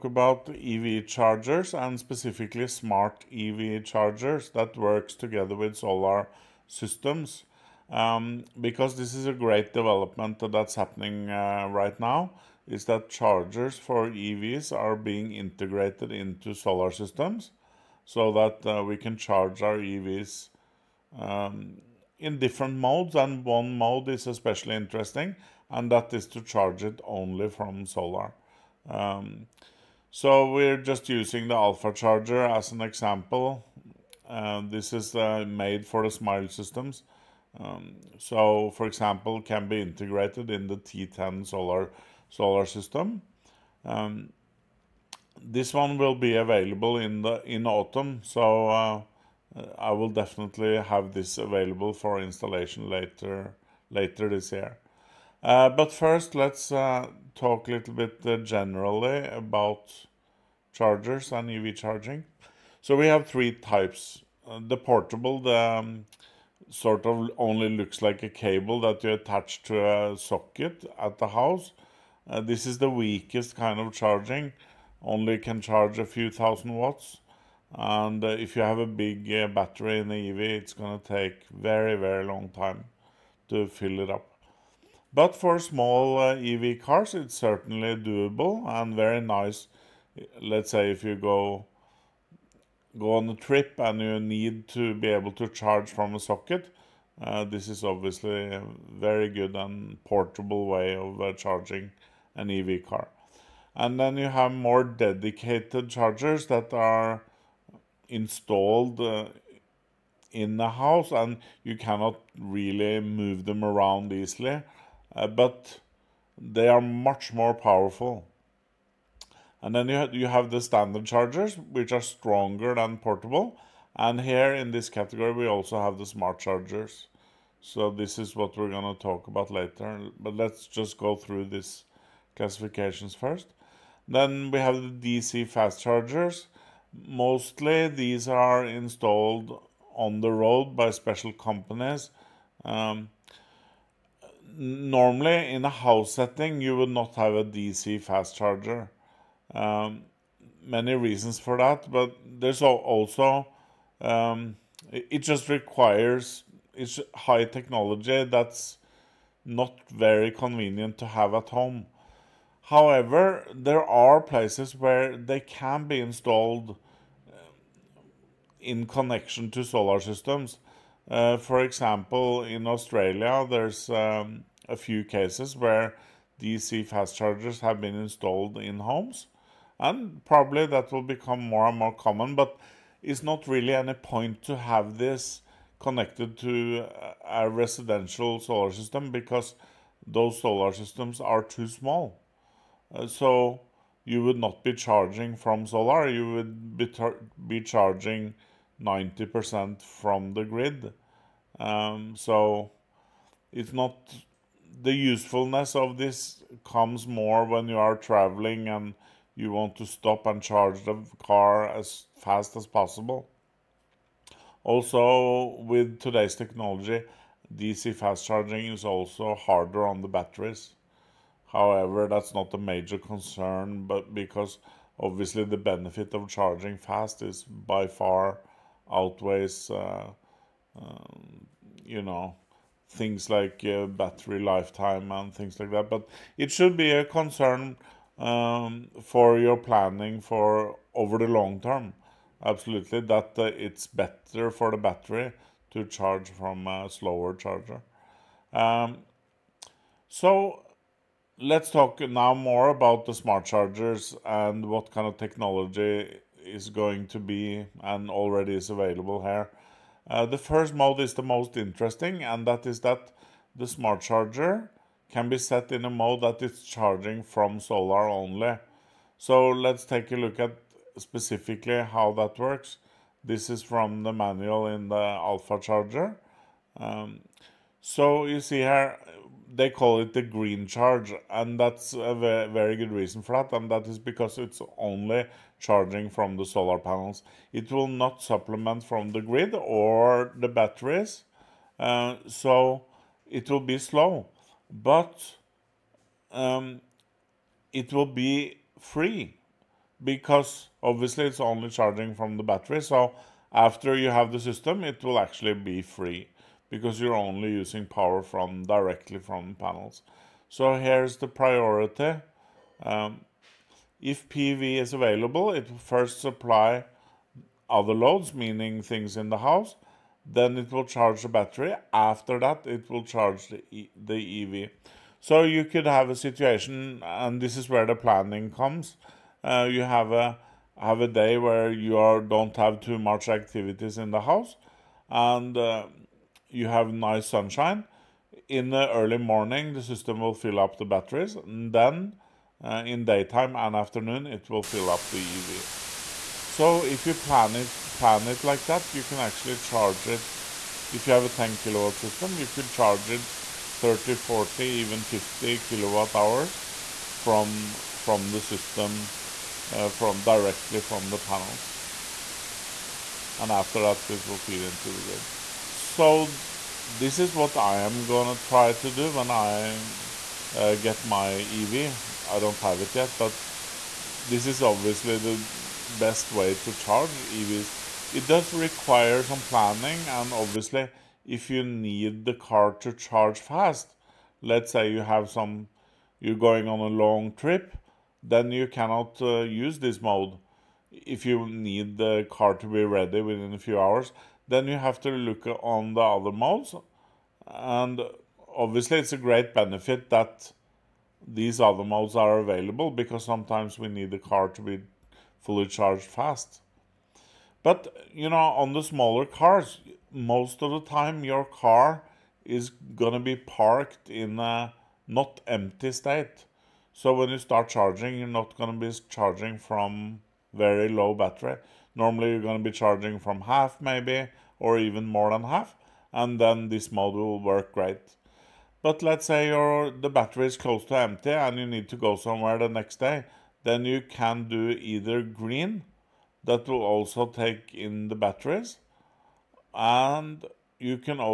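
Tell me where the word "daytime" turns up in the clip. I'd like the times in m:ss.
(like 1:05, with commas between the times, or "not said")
5:43.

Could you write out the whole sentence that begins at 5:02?
So after you have the system, it will actually be free because you're only using power from directly from panels.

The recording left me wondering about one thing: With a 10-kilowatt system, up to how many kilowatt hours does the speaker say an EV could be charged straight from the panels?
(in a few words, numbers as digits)
50.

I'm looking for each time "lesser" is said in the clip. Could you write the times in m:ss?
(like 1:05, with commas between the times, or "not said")
not said.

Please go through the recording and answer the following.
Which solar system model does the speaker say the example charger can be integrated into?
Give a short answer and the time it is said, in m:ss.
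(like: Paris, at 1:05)
T10, at 0:40.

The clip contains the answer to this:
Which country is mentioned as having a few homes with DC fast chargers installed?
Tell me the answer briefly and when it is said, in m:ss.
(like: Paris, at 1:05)
Australia, at 2:52.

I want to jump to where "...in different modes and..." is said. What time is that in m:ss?
0:22.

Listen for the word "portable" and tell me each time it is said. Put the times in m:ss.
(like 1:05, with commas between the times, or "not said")
1:04, 1:40, 2:02.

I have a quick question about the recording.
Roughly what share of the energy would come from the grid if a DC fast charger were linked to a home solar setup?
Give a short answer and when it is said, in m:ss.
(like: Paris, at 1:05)
90%, at 3:18.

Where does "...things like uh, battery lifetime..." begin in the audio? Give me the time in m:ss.
3:52.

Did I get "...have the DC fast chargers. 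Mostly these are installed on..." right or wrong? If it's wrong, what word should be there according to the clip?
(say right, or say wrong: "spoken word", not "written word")
right.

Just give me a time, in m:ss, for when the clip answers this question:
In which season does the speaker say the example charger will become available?
0:47.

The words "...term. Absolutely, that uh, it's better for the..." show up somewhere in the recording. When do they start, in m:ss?
4:01.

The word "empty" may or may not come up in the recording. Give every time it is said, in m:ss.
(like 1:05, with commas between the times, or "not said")
6:55, 7:10.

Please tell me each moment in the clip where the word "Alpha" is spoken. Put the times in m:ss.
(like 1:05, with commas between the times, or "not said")
0:31, 4:34.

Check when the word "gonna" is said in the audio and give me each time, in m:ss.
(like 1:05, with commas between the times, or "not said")
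6:08, 6:52, 6:58.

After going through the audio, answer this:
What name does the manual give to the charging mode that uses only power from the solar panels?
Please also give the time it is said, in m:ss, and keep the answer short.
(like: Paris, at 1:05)
Green charge, at 4:40.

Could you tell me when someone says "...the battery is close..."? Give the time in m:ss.
7:09.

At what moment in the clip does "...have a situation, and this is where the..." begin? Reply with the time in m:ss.
5:25.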